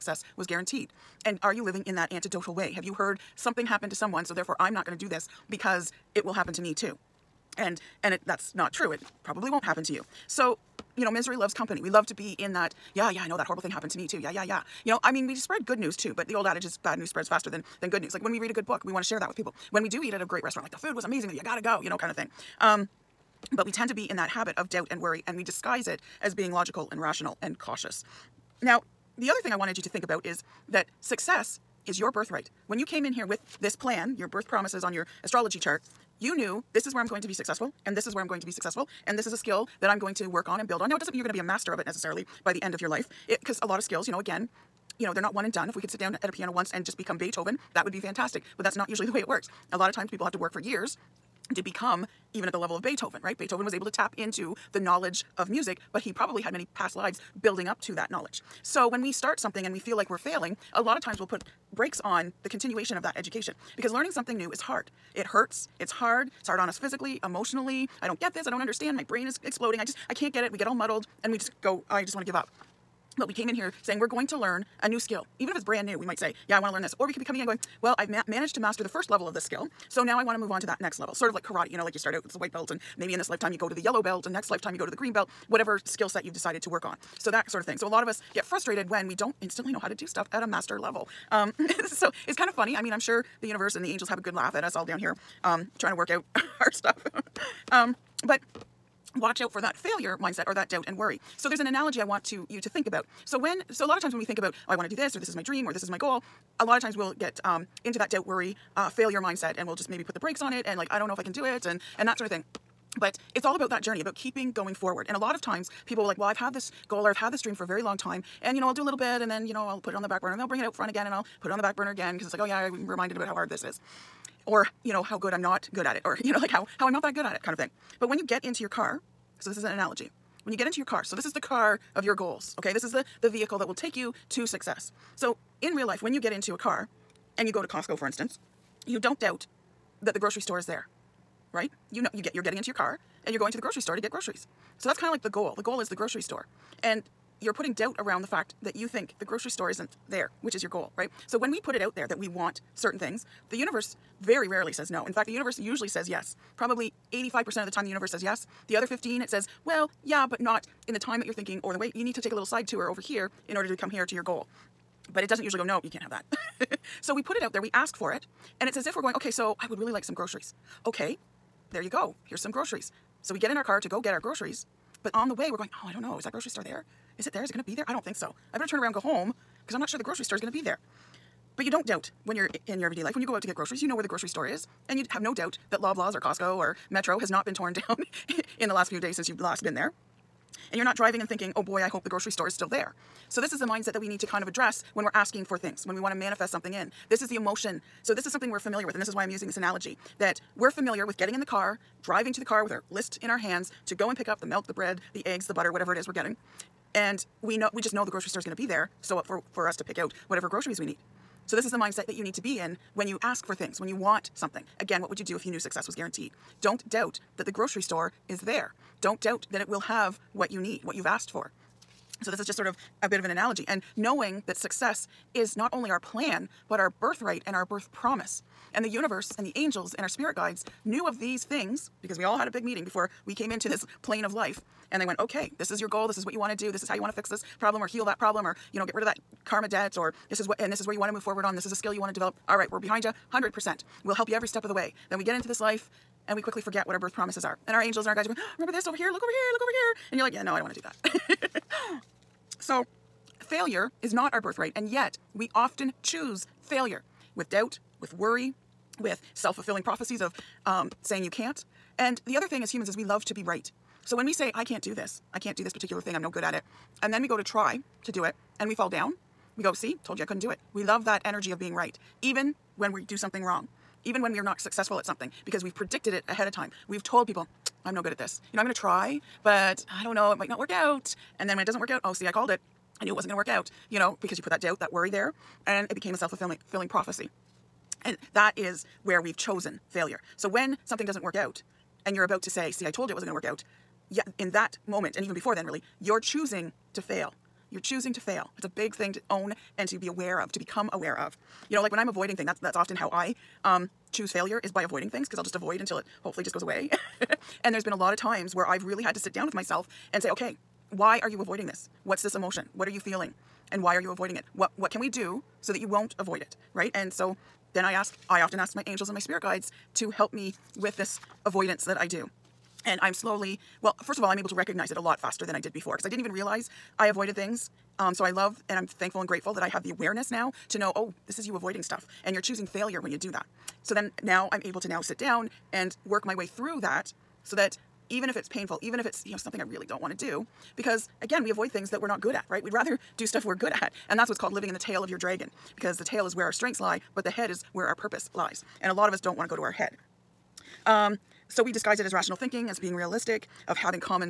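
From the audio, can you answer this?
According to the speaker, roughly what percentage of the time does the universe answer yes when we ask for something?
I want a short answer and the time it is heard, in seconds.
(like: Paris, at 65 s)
85%, at 157 s.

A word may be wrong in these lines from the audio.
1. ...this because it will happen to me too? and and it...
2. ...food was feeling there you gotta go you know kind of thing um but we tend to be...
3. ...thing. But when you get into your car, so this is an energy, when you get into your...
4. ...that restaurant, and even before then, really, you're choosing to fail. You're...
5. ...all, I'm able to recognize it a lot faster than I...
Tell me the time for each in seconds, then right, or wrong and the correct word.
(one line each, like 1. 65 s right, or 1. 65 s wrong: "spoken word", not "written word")
1. 5 s right
2. 20 s wrong: "amazing", not "feeling"
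3. 127 s wrong: "analogy", not "energy"
4. 294 s wrong: "moment", not "restaurant"
5. 324 s right.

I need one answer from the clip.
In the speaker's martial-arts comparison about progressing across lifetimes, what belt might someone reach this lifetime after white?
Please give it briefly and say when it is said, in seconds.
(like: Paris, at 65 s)
Yellow belt, at 83 s.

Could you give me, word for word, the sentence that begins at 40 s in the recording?
Now, it doesn't mean you're going to be a master of it necessarily by the end of your life.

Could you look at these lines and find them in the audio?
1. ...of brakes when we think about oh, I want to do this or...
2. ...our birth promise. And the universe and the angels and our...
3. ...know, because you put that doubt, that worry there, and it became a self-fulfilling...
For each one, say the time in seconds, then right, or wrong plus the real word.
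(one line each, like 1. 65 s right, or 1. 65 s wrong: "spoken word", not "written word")
1. 103 s wrong: "times", not "brakes"
2. 227 s right
3. 283 s right.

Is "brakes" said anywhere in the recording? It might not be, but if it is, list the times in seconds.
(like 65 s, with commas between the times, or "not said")
61 s, 110 s.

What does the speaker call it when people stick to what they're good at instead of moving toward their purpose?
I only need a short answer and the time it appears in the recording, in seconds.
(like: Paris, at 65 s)
Living in the tail of your dragon, at 344 s.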